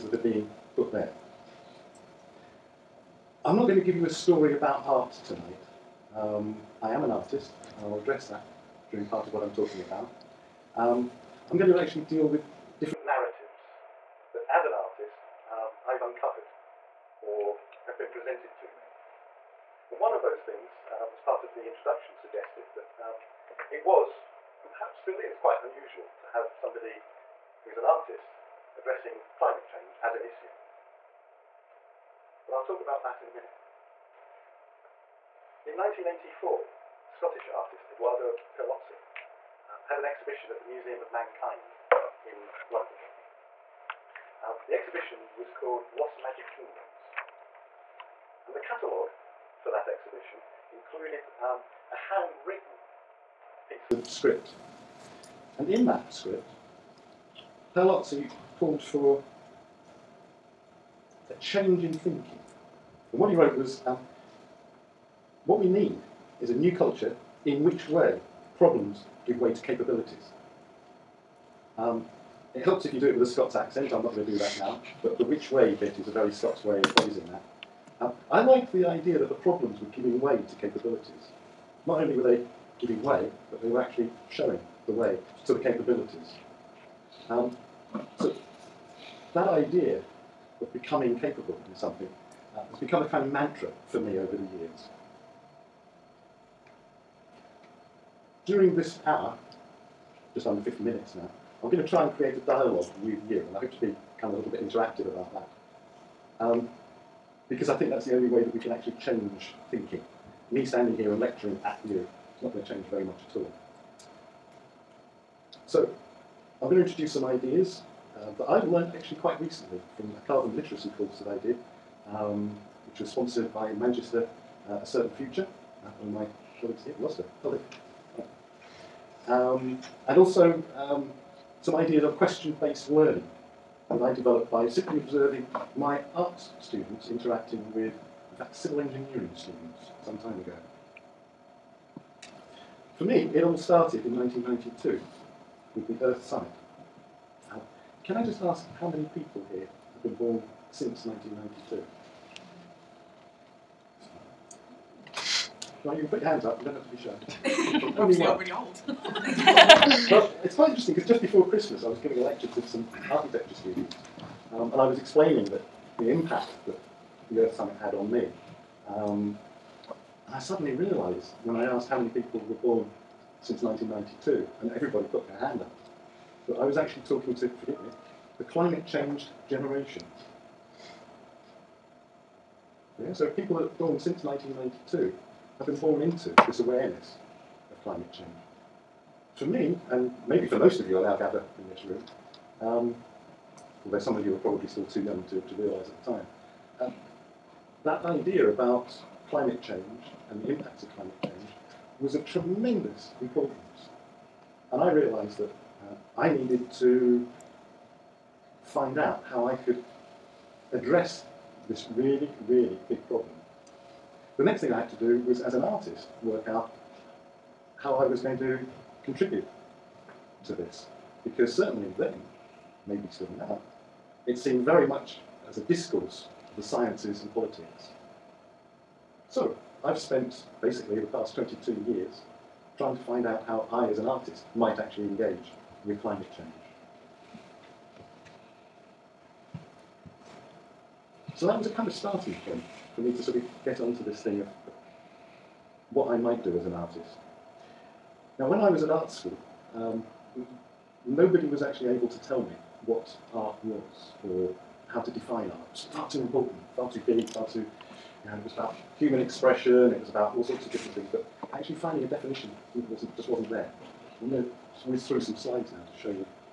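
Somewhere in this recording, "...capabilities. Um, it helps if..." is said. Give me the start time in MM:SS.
01:09.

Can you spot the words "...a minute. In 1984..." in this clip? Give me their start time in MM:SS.
00:33.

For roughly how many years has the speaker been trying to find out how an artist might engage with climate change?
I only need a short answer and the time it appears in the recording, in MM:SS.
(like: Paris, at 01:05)
22, at 03:51.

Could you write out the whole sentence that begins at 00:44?
Uh, the exhibition was called Lost Magic Kingdoms.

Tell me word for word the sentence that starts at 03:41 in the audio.
Because certainly then, maybe still now, it seemed very much as a discourse of the sciences and politics.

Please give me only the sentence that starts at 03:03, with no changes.
Yeah, so people that born since 1992 have been born into this awareness of climate change.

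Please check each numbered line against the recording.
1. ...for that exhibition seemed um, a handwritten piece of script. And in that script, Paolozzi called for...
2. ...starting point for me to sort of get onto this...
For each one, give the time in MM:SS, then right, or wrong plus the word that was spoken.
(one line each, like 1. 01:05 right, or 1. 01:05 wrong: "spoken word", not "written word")
1. 00:49 wrong: "included", not "seemed"
2. 04:01 right.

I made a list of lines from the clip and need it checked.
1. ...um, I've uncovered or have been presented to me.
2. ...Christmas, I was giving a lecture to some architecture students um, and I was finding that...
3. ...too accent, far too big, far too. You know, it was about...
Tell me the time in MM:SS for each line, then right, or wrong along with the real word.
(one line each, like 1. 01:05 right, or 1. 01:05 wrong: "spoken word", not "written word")
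1. 00:15 right
2. 02:41 wrong: "explaining", not "finding"
3. 04:16 wrong: "important", not "accent".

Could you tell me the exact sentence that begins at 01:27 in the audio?
Um, so that idea of becoming capable in something uh, has become a kind of mantra for me over the years.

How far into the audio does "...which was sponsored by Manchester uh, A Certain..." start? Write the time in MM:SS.
02:02.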